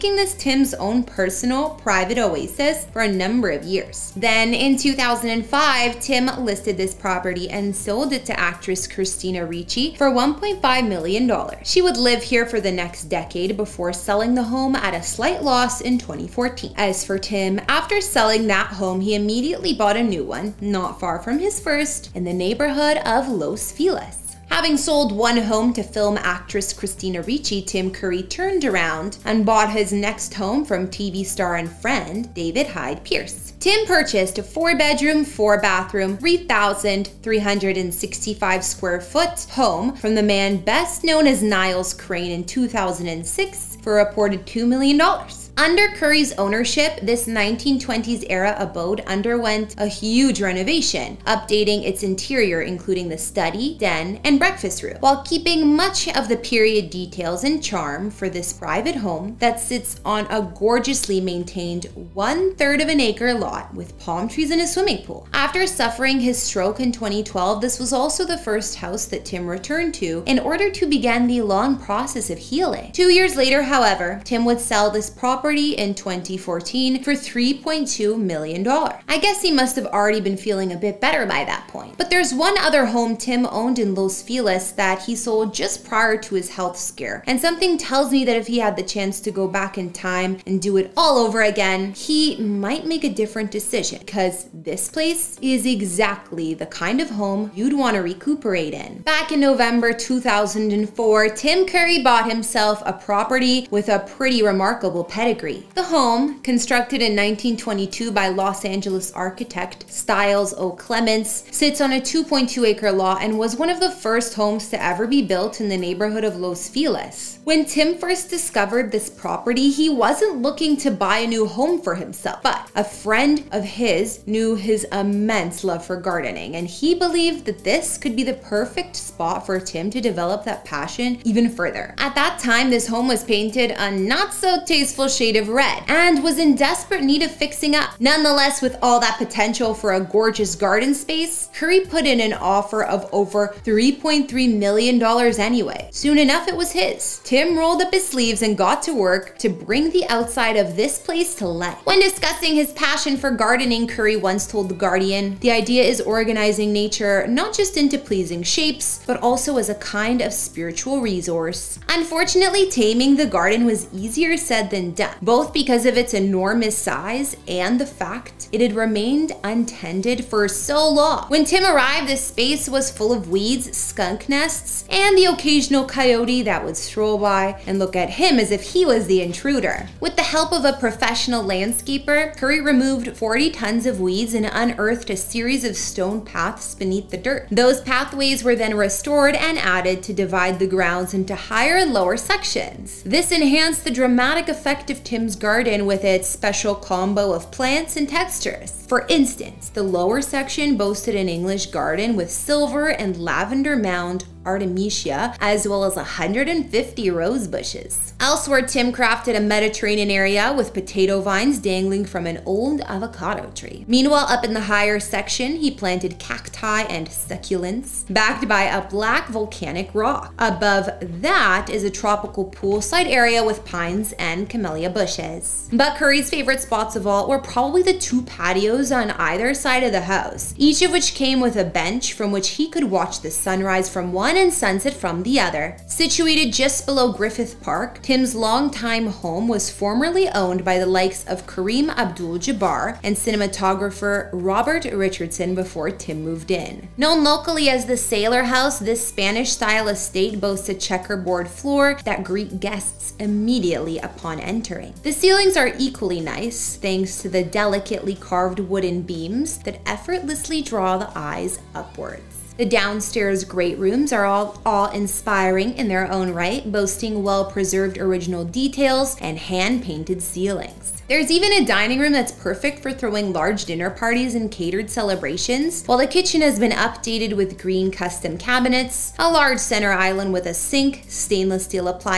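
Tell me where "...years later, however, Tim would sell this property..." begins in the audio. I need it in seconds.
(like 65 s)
73 s.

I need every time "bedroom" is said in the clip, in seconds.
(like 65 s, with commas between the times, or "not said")
34 s.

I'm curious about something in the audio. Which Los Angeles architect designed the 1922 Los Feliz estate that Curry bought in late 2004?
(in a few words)
Stiles O. Clements.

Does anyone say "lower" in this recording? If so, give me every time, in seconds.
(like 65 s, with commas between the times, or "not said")
191 s, 199 s.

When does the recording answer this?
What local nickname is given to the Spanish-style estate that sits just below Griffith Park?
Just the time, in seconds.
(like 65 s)
247 s.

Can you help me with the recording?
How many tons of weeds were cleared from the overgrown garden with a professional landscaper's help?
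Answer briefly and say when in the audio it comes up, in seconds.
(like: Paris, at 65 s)
40, at 183 s.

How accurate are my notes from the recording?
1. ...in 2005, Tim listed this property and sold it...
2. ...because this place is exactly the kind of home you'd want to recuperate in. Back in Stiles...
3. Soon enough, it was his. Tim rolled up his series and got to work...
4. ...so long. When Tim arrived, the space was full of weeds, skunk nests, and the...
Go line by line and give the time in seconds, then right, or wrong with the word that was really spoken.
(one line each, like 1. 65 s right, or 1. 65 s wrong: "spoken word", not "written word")
1. 4 s right
2. 93 s wrong: "November", not "Stiles"
3. 145 s wrong: "sleeves", not "series"
4. 170 s right.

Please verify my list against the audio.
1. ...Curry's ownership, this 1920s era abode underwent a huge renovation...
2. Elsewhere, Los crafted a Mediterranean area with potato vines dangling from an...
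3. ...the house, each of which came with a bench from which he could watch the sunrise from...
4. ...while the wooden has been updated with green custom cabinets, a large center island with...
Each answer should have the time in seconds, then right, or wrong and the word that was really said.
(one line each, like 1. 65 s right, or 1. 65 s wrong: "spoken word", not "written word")
1. 45 s right
2. 208 s wrong: "Tim", not "Los"
3. 229 s right
4. 275 s wrong: "kitchen", not "wooden".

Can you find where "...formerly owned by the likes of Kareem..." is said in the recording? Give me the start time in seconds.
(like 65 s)
239 s.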